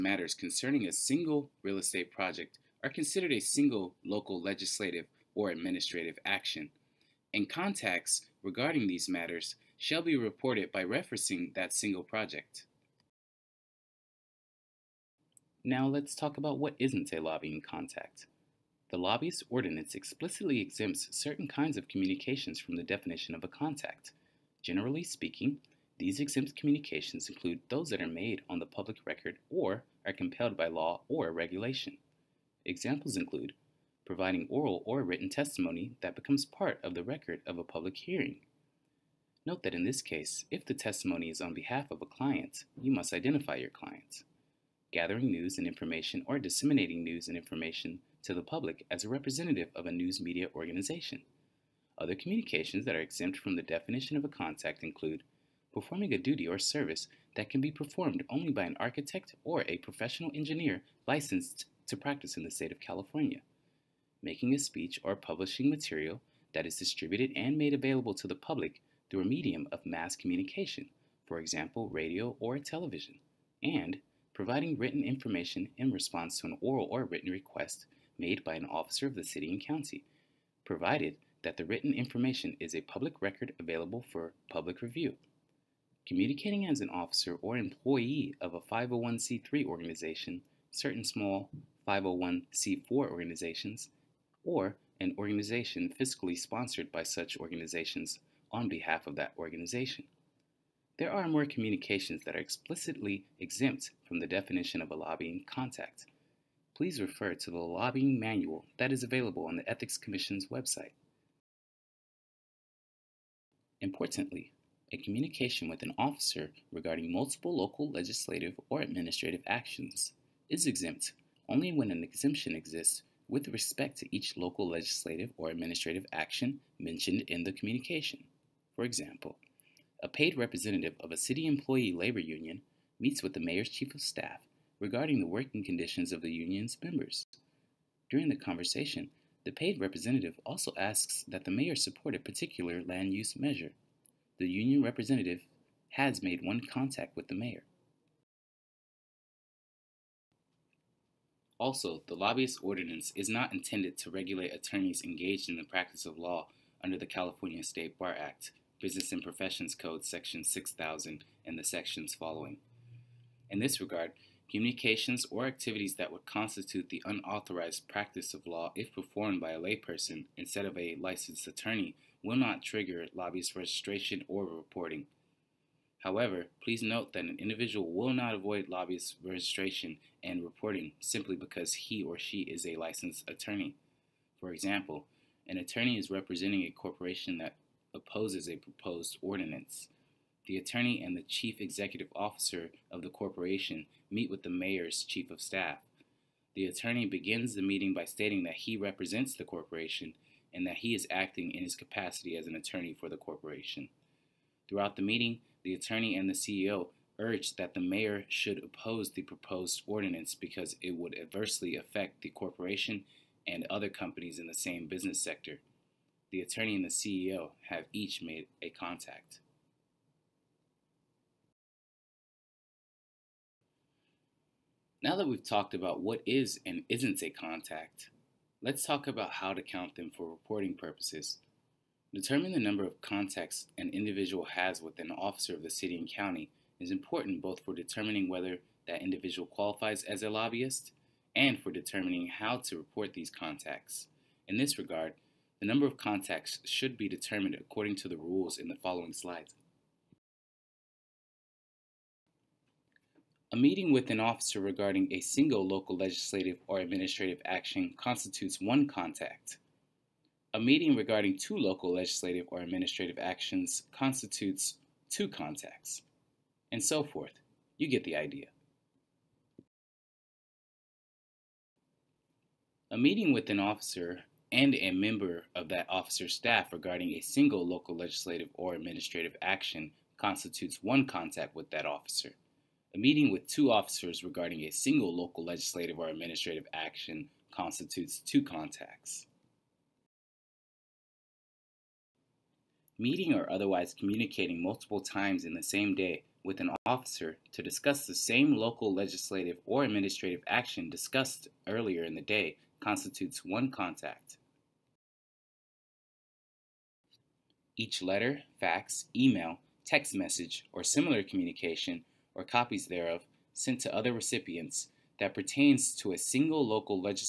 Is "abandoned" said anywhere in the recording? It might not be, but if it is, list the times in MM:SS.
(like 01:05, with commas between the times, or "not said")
not said.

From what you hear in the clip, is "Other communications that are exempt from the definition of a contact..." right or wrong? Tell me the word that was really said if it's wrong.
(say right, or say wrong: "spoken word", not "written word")
right.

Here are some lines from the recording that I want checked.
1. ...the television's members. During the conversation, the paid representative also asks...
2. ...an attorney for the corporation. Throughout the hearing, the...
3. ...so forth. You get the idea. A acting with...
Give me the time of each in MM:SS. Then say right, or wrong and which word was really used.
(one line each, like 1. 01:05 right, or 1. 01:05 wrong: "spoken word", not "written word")
1. 02:16 wrong: "union", not "television"
2. 03:22 wrong: "meeting", not "hearing"
3. 04:26 wrong: "meeting", not "acting".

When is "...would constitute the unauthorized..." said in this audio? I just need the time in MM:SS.
02:46.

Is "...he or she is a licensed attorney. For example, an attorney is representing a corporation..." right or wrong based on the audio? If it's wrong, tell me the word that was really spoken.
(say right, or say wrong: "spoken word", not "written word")
right.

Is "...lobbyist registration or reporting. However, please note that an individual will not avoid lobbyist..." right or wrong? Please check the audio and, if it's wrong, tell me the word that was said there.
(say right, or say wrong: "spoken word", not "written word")
right.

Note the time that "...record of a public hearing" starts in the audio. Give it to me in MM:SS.
00:37.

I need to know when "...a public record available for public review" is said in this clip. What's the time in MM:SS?
01:22.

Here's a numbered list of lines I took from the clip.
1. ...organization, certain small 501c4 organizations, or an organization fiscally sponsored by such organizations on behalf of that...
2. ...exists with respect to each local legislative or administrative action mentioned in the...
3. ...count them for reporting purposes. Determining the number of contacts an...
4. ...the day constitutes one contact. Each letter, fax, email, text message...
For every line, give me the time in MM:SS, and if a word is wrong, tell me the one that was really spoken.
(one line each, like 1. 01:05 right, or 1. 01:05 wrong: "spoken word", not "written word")
1. 01:29 right
2. 02:02 right
3. 03:49 right
4. 05:02 right.